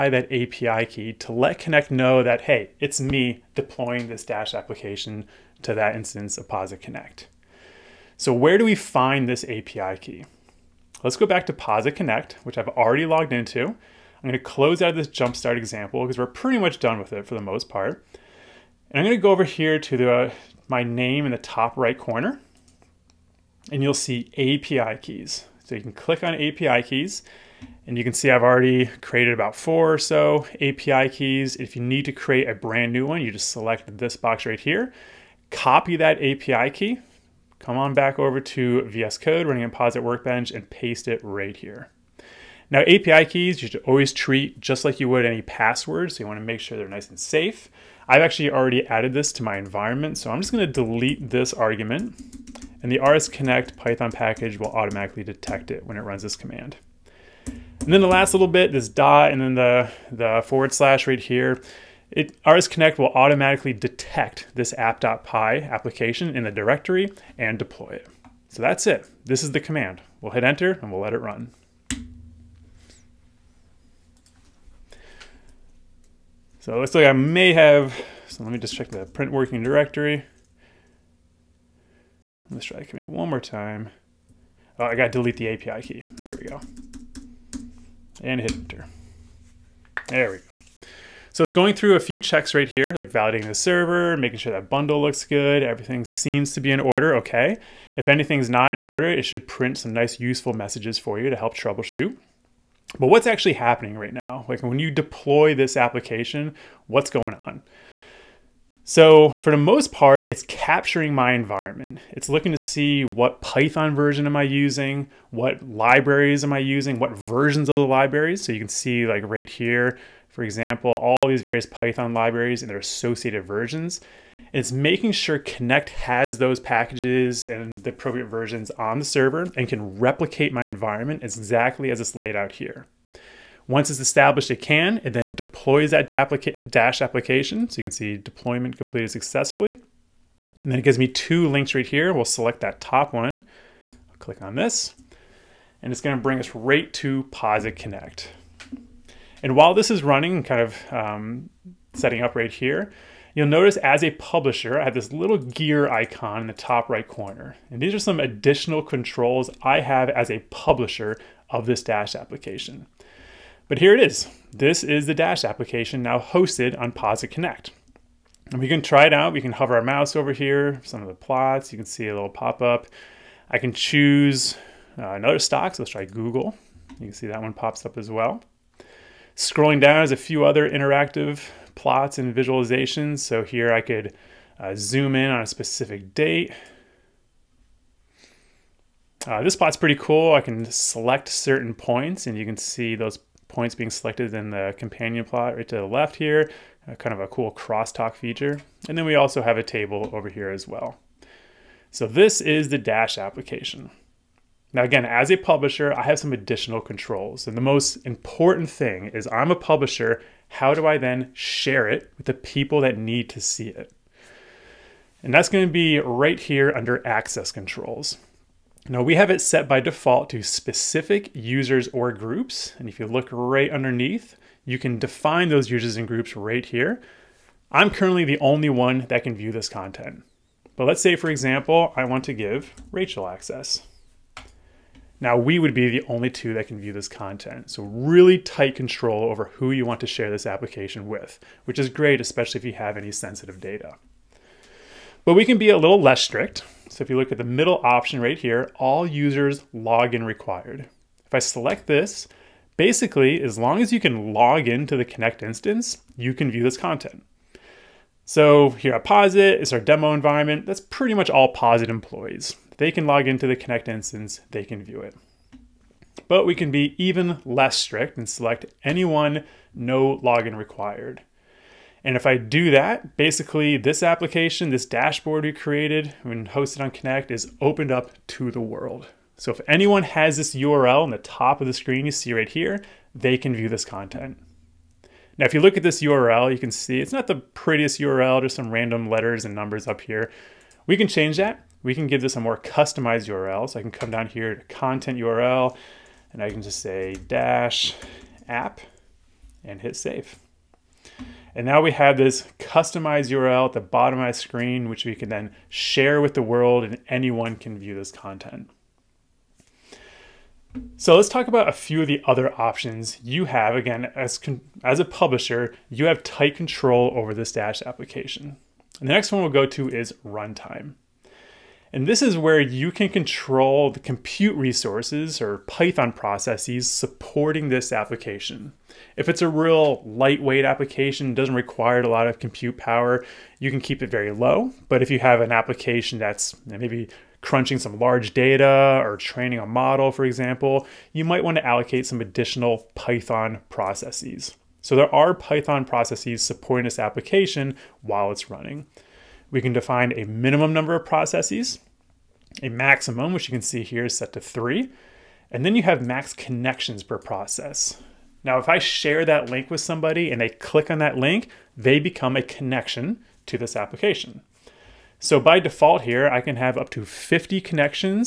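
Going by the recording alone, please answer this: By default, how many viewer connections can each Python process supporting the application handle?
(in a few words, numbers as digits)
50.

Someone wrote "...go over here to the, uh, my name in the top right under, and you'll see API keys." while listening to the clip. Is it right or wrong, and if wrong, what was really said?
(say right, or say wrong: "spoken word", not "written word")
wrong: "corner", not "under".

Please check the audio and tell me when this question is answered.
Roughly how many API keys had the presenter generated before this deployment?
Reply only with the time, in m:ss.
0:29.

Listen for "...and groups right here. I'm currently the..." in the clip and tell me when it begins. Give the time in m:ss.
3:45.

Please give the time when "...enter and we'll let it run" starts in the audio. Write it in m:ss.
1:10.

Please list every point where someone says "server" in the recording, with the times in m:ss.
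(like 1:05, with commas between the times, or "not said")
1:33, 2:09.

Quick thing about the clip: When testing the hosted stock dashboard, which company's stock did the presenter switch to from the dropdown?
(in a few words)
Google.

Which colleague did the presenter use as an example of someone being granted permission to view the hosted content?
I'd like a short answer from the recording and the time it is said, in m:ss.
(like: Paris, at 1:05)
Rachel, at 3:52.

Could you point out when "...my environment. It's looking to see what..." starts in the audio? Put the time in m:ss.
1:51.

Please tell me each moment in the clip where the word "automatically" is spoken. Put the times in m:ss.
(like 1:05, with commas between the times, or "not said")
0:54, 1:03.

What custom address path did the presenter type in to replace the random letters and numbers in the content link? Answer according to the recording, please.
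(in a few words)
dash app.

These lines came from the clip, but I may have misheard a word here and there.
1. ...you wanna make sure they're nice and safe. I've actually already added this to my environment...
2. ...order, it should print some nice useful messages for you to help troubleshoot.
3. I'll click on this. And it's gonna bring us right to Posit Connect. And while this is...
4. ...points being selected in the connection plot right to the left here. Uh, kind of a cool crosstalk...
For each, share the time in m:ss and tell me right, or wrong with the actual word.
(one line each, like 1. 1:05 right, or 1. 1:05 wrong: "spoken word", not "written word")
1. 0:46 right
2. 1:38 right
3. 2:23 right
4. 3:13 wrong: "companion", not "connection".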